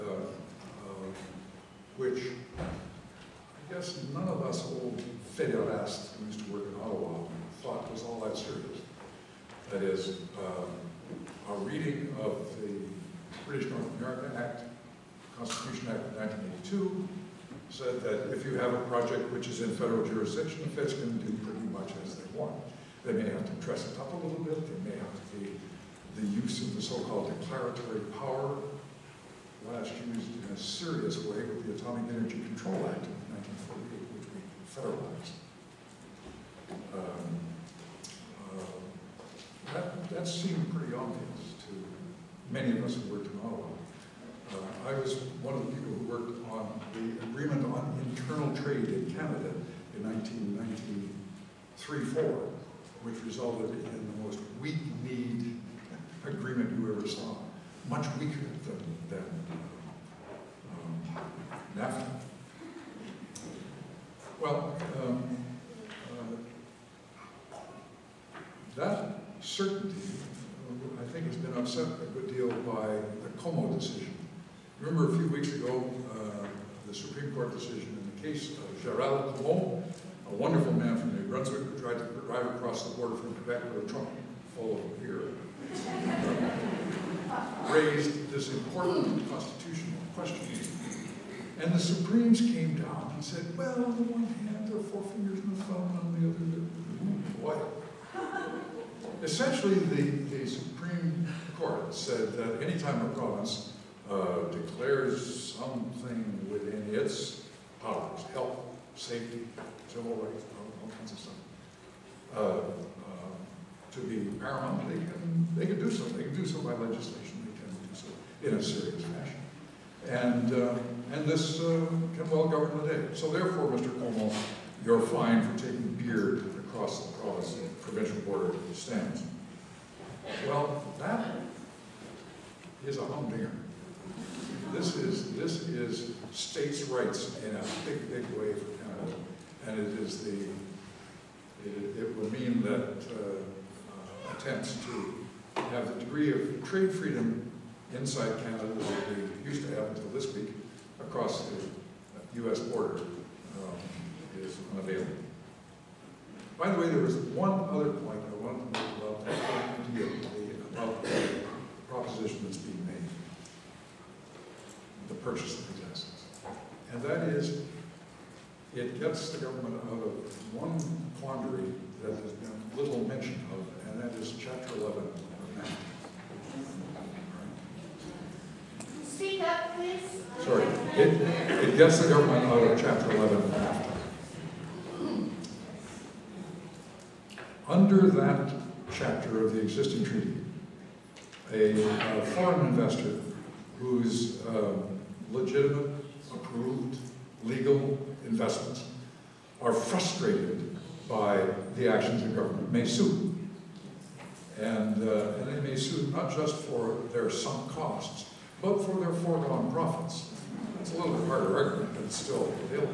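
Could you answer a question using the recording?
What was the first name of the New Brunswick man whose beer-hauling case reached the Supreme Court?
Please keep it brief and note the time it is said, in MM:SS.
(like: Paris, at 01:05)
Gerald, at 01:18.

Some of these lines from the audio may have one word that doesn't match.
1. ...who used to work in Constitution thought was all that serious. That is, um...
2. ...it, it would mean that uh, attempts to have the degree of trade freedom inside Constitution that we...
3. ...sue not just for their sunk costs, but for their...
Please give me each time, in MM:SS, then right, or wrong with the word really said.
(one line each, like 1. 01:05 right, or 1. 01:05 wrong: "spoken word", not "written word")
1. 00:06 wrong: "Ottawa", not "Constitution"
2. 02:21 wrong: "Canada", not "Constitution"
3. 03:25 right.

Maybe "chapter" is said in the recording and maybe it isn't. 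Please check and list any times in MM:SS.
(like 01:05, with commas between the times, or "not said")
02:54, 03:02, 03:08.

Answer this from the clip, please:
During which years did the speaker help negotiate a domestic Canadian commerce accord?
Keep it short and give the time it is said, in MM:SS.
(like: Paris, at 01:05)
1993-4, at 00:51.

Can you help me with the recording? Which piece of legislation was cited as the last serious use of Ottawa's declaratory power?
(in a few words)
Atomic Energy Control Act.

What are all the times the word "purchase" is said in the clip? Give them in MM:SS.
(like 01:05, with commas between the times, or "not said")
02:45.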